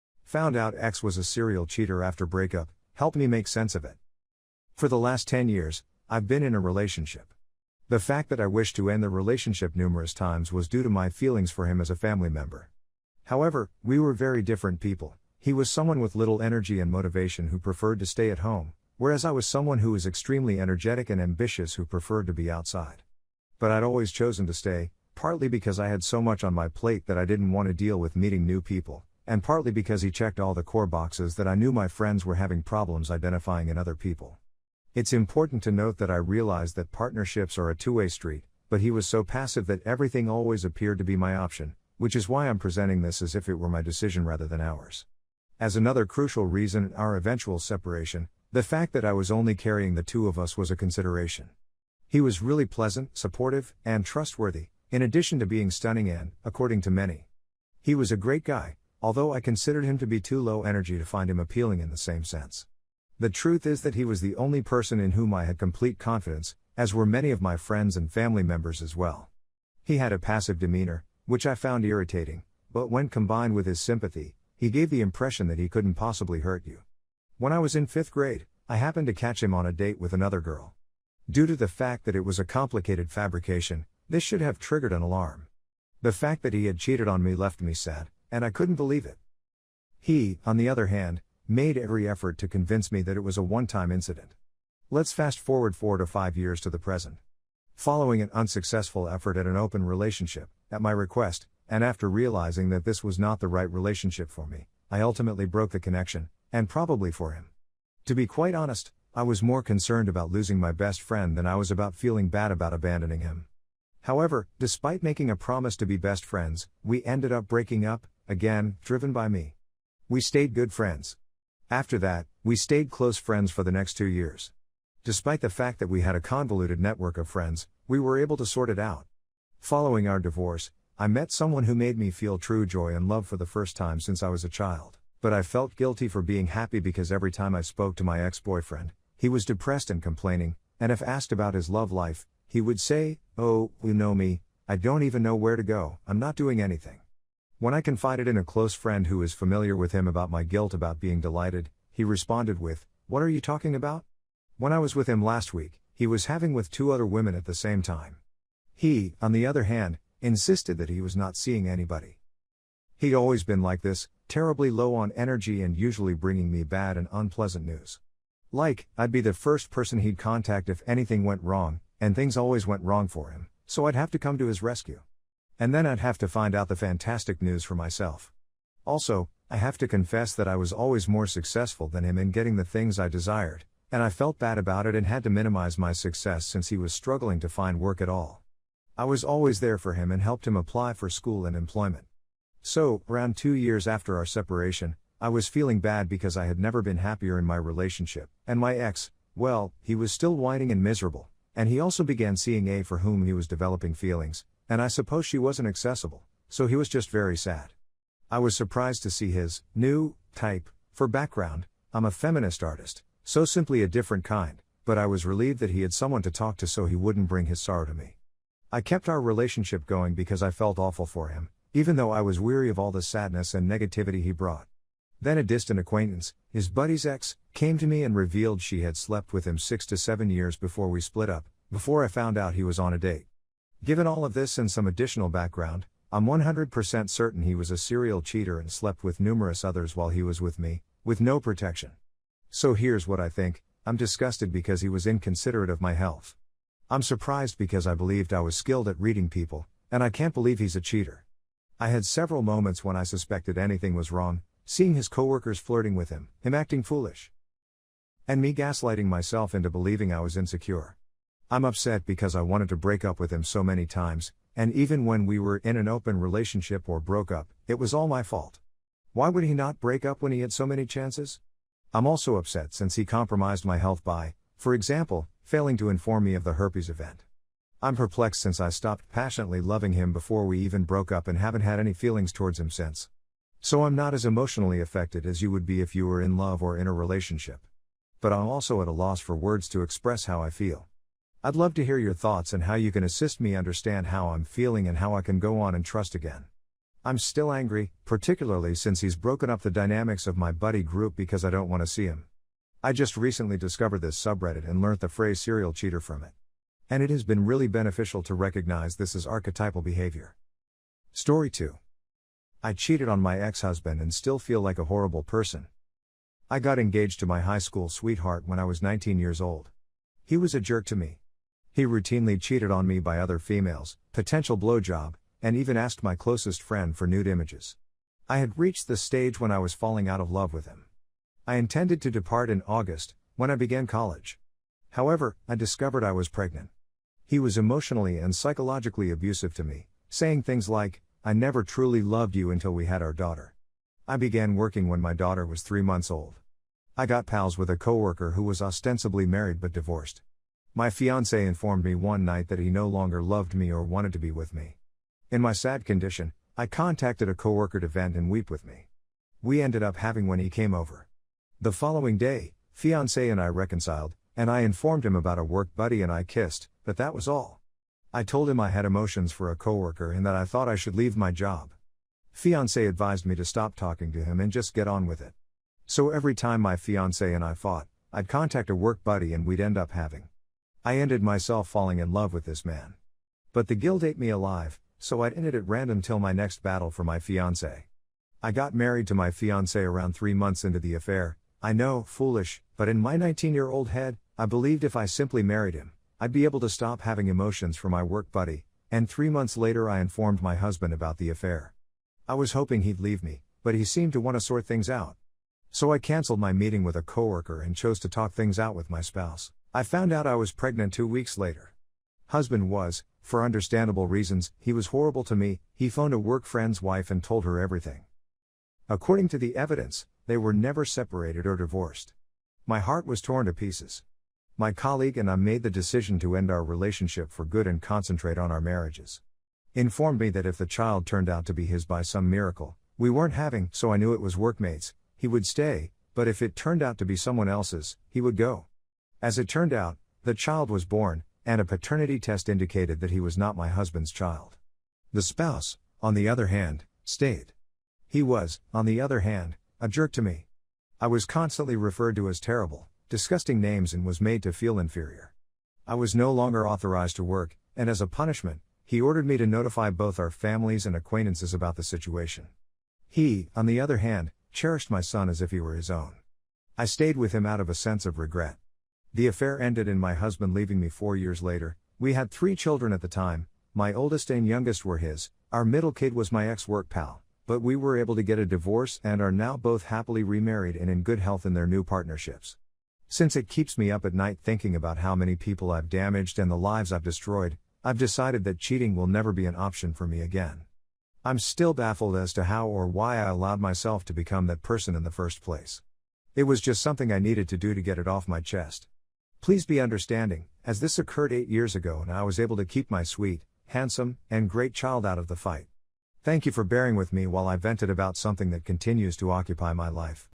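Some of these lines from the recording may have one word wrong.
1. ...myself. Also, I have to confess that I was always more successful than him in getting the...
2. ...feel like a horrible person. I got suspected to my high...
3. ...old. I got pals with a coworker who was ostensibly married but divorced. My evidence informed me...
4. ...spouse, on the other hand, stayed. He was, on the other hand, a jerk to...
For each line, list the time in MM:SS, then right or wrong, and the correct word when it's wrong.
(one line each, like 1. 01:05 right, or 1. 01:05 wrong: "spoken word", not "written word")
1. 02:57 right
2. 05:14 wrong: "engaged", not "suspected"
3. 05:46 wrong: "fiance", not "evidence"
4. 07:25 right.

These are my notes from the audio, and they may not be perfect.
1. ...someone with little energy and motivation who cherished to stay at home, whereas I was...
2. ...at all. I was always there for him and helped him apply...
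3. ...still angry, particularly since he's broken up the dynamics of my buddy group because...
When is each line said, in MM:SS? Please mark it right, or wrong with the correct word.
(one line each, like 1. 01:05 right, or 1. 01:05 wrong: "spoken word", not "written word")
1. 00:15 wrong: "preferred", not "cherished"
2. 03:08 right
3. 04:57 right.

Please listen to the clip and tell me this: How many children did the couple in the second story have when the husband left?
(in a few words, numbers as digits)
3.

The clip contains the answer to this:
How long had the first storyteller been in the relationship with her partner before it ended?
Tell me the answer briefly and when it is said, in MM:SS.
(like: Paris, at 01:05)
10 years, at 00:05.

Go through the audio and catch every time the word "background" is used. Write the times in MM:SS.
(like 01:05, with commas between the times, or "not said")
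03:31, 03:55.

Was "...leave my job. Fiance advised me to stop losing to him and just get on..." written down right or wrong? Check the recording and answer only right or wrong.
wrong.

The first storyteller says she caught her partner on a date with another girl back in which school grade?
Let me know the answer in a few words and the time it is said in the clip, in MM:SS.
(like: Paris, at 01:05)
Fifth grade, at 01:17.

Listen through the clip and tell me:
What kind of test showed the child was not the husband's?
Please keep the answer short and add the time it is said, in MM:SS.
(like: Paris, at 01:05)
Paternity test, at 07:21.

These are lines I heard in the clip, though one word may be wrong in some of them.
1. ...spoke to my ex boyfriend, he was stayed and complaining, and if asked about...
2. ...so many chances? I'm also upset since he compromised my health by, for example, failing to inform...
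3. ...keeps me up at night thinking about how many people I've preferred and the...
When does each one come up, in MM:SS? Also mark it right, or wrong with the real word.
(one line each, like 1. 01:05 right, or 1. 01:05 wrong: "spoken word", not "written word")
1. 02:17 wrong: "depressed", not "stayed"
2. 04:30 right
3. 08:03 wrong: "damaged", not "preferred".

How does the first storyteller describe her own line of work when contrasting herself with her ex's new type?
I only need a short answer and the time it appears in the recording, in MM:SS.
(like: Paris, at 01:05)
Feminist artist, at 03:32.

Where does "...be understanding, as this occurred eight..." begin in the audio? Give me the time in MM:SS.
08:19.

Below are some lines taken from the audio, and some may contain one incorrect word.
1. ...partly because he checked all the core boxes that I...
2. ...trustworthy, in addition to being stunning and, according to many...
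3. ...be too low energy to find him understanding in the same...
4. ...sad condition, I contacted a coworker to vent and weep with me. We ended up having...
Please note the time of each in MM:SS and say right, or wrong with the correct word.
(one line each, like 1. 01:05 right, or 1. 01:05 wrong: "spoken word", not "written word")
1. 00:29 right
2. 00:54 right
3. 01:00 wrong: "appealing", not "understanding"
4. 05:55 right.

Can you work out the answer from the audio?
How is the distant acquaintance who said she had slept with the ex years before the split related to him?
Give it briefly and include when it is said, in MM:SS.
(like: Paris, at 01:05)
His buddy's ex, at 03:46.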